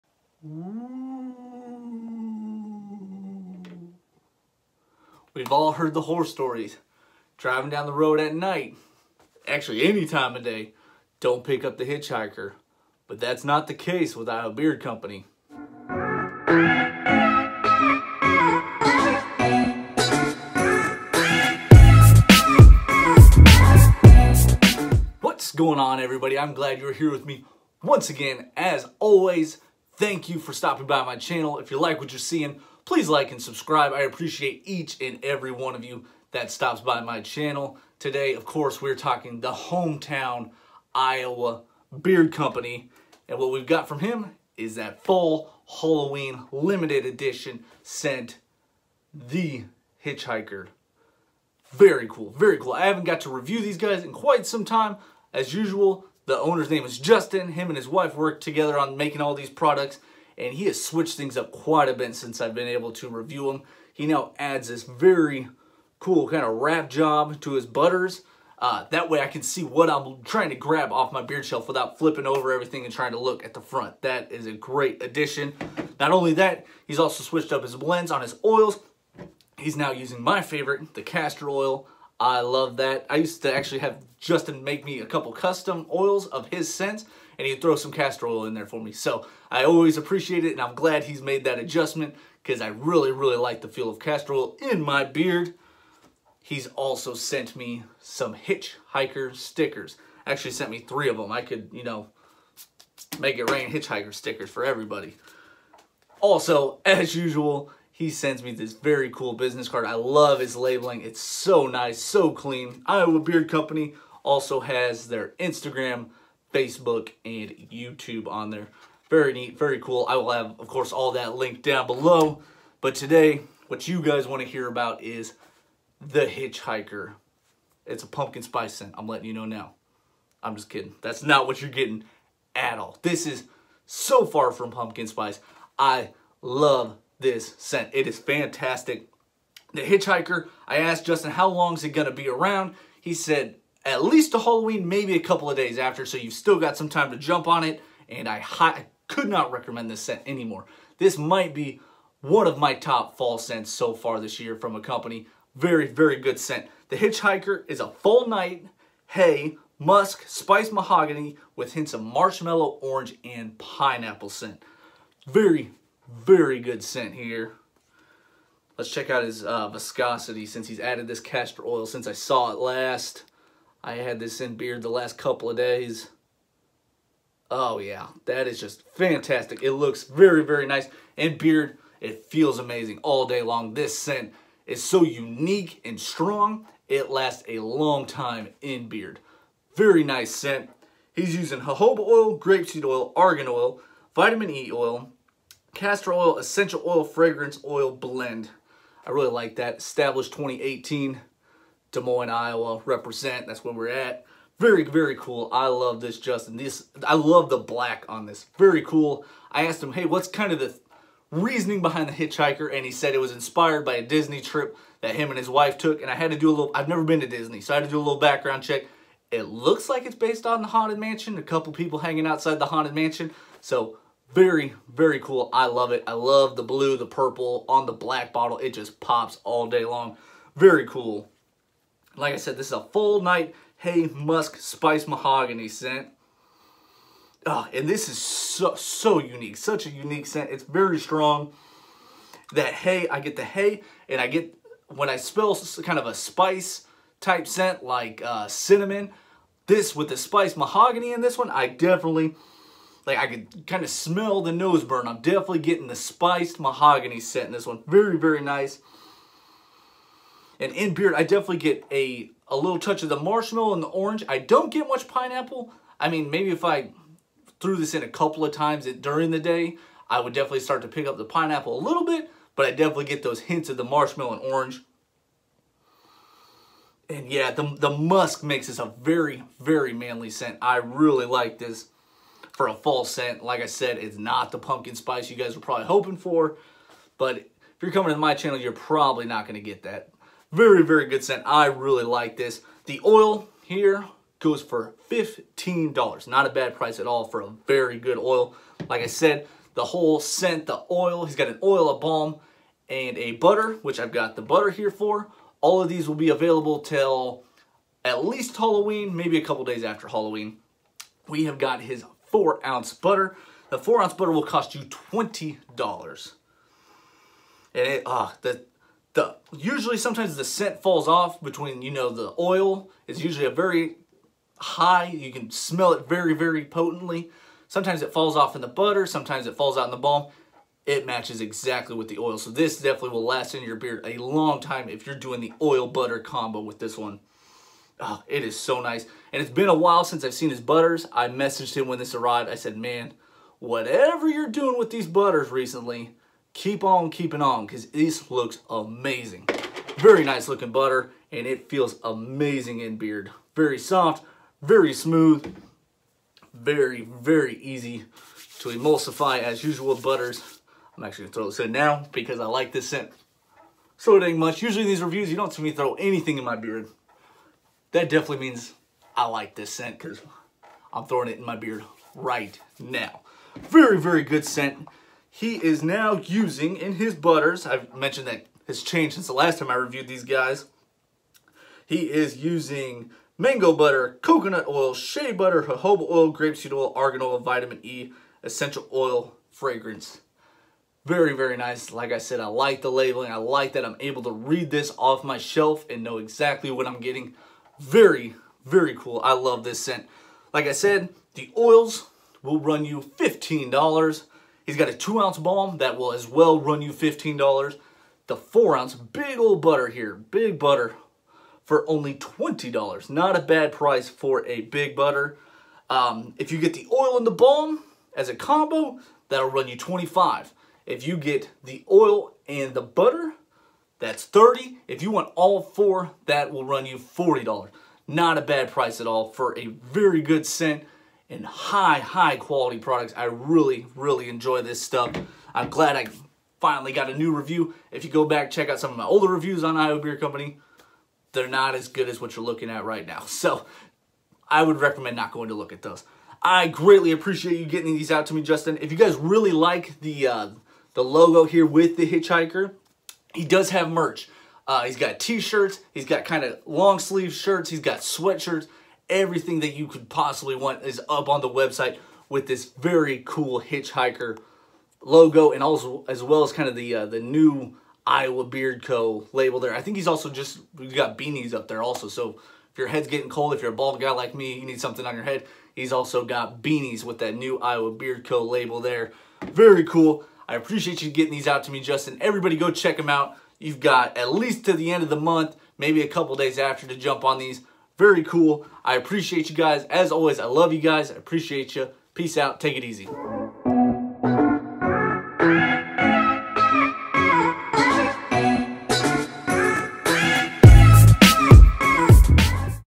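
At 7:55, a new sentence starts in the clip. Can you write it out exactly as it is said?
He's also got beanies with that new Iowa Beard Co.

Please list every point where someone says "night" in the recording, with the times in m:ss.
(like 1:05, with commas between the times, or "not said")
0:08, 2:38, 3:53.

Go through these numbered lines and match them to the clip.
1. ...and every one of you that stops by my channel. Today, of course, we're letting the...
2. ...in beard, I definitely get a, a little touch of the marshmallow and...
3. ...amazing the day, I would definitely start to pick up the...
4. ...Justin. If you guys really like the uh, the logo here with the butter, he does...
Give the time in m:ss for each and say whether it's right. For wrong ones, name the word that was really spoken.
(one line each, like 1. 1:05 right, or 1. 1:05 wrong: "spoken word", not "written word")
1. 0:34 wrong: "talking", not "letting"
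2. 4:20 right
3. 4:28 wrong: "during", not "amazing"
4. 7:28 wrong: "hitchhiker", not "butter".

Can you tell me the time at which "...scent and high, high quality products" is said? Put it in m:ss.
7:10.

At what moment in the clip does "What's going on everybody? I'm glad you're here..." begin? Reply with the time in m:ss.
0:25.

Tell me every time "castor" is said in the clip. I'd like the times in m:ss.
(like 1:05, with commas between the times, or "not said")
1:21, 1:27, 1:33, 2:51, 3:15.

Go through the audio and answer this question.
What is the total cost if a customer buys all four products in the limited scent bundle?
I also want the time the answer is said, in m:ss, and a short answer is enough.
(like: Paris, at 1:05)
$40, at 7:06.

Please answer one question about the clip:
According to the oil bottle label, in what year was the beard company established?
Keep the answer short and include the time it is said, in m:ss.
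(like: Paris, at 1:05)
2018, at 3:19.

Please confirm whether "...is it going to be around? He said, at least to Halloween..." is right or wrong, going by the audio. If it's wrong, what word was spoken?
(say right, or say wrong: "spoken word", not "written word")
right.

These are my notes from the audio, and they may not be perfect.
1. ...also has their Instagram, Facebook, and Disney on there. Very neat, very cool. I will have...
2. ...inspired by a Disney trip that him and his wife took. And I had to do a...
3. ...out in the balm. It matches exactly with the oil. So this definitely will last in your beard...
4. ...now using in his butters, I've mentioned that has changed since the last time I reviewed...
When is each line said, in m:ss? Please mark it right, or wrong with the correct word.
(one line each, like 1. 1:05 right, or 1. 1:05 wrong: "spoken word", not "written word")
1. 1:54 wrong: "YouTube", not "Disney"
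2. 3:33 right
3. 5:29 right
4. 6:15 right.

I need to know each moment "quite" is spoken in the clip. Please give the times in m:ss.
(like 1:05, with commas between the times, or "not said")
0:54, 1:01.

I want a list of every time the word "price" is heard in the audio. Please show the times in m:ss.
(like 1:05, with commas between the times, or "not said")
4:56, 6:53, 7:08.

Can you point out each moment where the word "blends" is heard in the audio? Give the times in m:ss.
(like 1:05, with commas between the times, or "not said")
1:17, 3:17.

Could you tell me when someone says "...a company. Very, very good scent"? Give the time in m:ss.
2:34.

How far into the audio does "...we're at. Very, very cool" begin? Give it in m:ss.
3:23.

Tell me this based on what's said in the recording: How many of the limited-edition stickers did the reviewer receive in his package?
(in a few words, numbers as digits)
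3.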